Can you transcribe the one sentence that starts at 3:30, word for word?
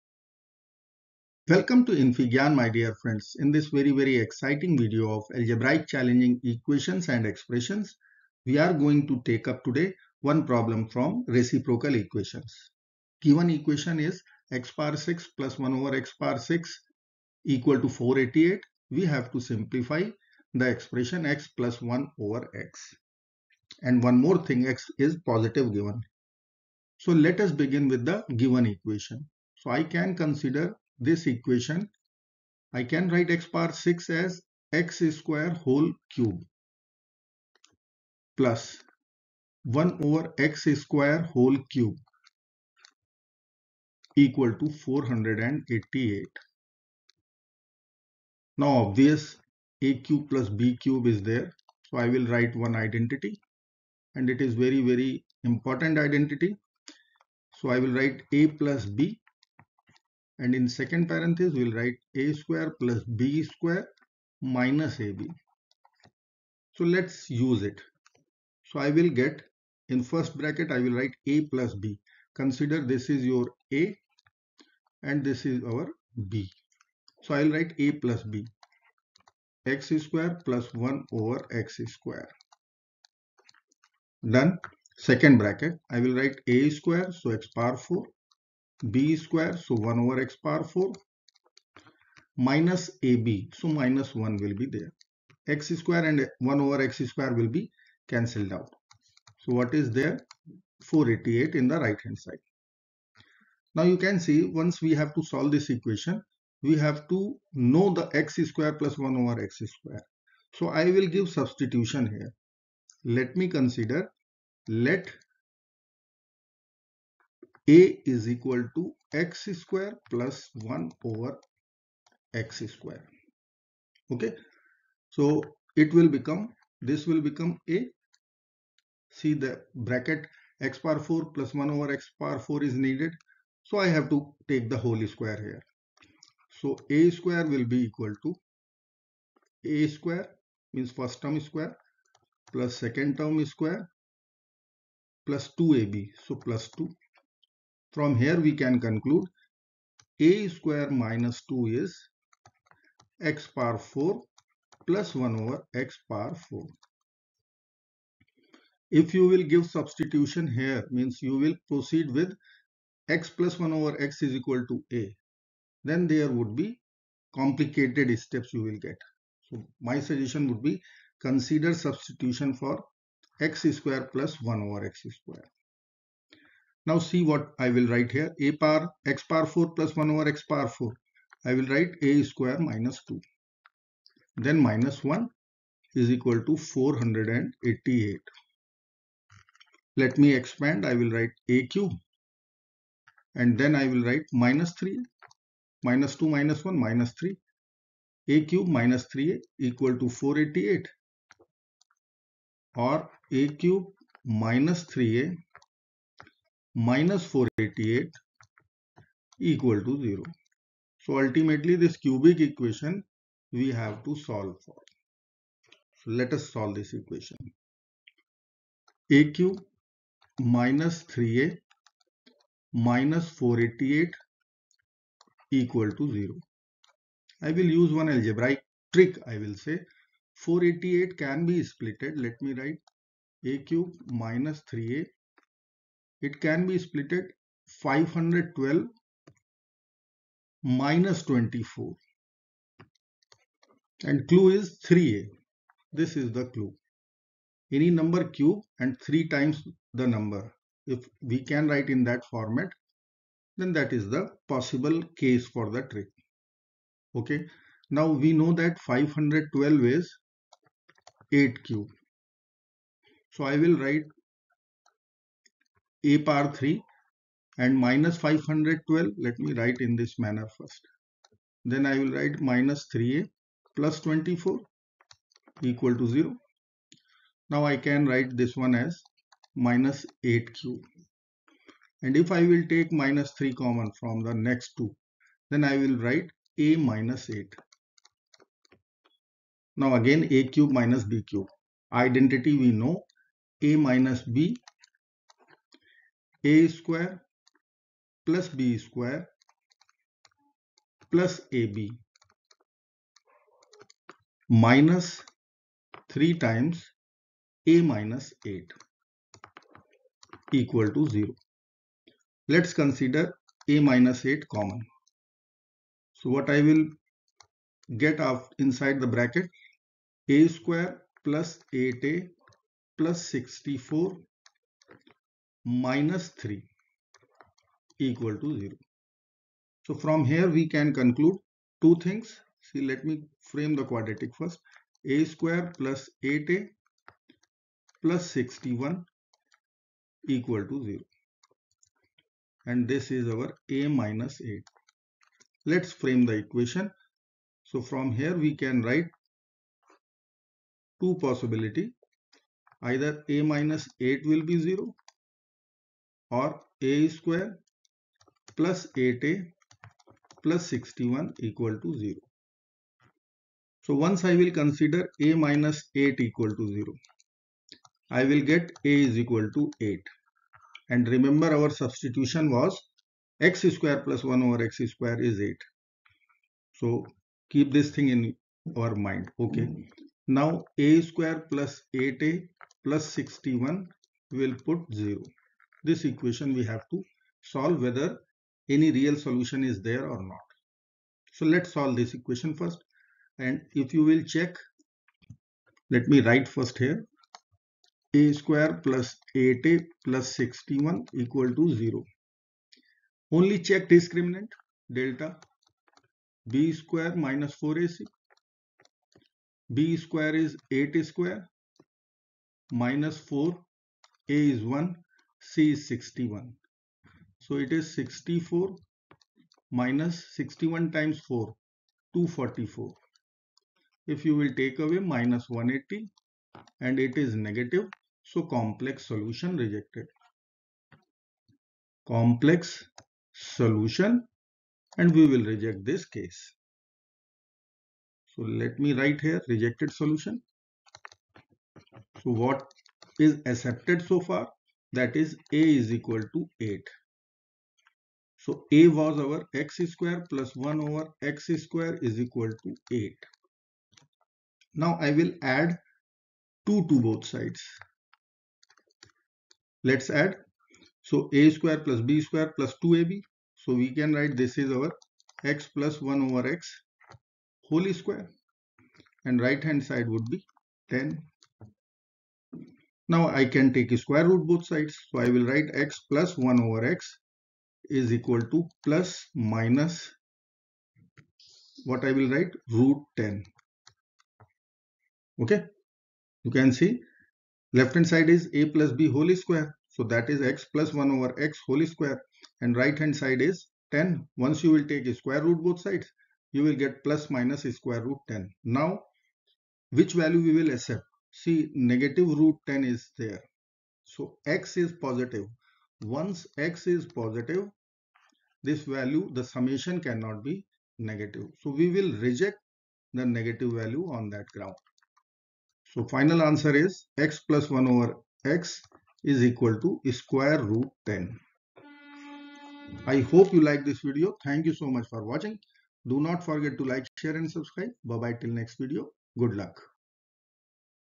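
So ultimately this cubic equation we have to solve for.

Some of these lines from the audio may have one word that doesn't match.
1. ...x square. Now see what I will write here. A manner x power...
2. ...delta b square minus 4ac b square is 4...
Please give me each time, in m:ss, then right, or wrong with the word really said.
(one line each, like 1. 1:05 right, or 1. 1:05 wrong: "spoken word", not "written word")
1. 2:54 wrong: "power", not "manner"
2. 6:44 wrong: "8", not "4".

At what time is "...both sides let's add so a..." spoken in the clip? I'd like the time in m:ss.
7:37.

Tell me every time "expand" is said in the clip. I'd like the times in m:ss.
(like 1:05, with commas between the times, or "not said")
3:10.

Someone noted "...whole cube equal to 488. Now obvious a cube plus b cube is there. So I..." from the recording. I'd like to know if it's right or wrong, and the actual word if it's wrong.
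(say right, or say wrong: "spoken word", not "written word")
right.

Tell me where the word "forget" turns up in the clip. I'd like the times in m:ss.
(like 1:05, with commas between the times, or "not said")
8:46.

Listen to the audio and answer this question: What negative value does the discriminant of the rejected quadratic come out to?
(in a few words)
-180.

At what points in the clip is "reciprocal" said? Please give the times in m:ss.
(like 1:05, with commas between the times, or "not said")
0:11.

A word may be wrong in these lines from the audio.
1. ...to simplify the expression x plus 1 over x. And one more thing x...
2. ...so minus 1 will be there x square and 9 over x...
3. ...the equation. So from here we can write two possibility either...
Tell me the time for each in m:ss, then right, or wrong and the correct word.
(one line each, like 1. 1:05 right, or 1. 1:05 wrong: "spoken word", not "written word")
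1. 0:19 right
2. 1:33 wrong: "1", not "9"
3. 5:46 right.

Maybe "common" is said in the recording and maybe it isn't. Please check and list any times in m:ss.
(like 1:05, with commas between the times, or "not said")
4:43, 5:14.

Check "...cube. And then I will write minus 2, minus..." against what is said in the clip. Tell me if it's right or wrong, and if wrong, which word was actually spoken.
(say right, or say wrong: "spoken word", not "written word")
wrong: "3", not "2".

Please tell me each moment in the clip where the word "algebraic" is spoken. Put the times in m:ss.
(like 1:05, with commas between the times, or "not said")
0:05, 3:48.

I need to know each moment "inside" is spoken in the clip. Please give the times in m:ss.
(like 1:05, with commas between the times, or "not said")
5:18.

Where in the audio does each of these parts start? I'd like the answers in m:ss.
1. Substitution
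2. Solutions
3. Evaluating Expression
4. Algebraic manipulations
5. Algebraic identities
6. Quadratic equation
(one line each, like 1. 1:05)
1. 1:58
2. 7:26
3. 8:33
4. 4:00
5. 0:52
6. 6:02.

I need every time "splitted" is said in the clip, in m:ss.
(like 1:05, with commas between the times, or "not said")
3:51, 3:56.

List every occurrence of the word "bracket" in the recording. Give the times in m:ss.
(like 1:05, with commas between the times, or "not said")
1:10, 1:25, 2:09, 5:19.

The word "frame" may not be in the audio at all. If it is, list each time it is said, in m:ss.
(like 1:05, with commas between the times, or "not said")
5:33, 5:45.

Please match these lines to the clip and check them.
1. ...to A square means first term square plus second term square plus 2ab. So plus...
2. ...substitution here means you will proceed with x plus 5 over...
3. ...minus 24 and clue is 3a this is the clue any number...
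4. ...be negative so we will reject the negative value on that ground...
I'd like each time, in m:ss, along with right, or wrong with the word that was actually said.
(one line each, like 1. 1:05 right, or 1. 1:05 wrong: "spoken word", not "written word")
1. 2:18 right
2. 2:39 wrong: "1", not "5"
3. 4:00 right
4. 8:30 right.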